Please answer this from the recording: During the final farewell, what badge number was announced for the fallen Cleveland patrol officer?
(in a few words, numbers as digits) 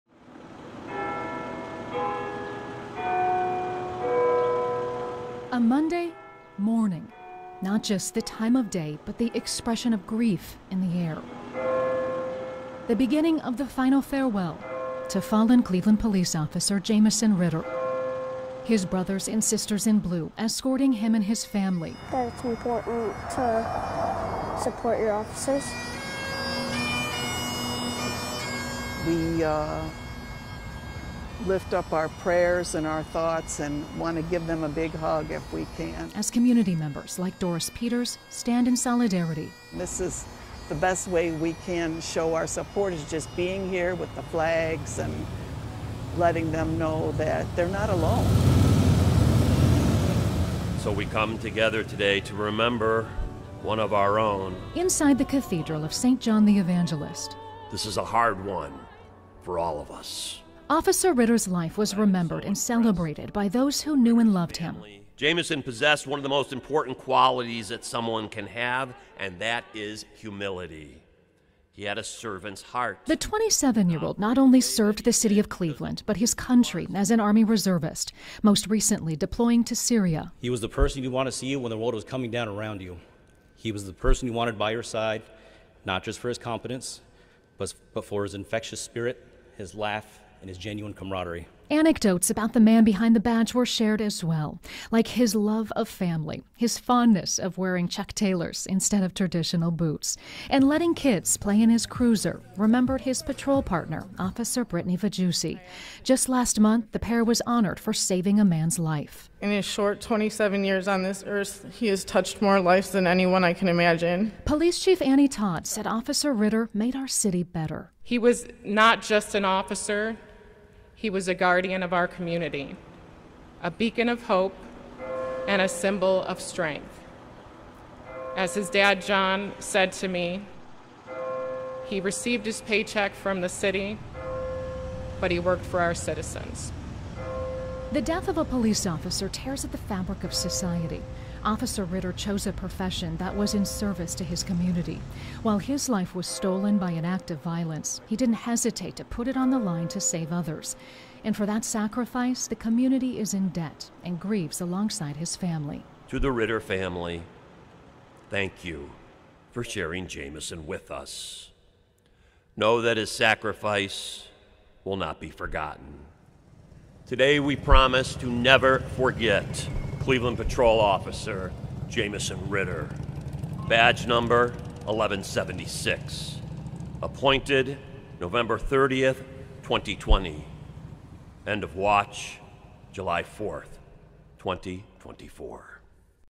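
1176.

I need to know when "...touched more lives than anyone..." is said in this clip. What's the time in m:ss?
1:52.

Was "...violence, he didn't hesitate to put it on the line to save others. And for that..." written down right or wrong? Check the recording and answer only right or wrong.
right.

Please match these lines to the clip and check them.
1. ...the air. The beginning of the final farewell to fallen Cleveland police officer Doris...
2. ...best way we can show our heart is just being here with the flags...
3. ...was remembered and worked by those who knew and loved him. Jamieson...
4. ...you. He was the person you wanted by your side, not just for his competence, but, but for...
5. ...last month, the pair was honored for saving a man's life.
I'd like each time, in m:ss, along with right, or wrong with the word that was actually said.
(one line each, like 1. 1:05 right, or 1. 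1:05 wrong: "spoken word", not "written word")
1. 0:10 wrong: "Jamieson", not "Doris"
2. 0:40 wrong: "support", not "heart"
3. 1:01 wrong: "celebrated", not "worked"
4. 1:22 right
5. 1:46 right.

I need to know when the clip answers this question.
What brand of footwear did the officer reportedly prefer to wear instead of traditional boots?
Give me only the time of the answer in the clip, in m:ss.
1:37.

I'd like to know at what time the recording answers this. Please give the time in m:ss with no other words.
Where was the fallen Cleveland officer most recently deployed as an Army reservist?
1:19.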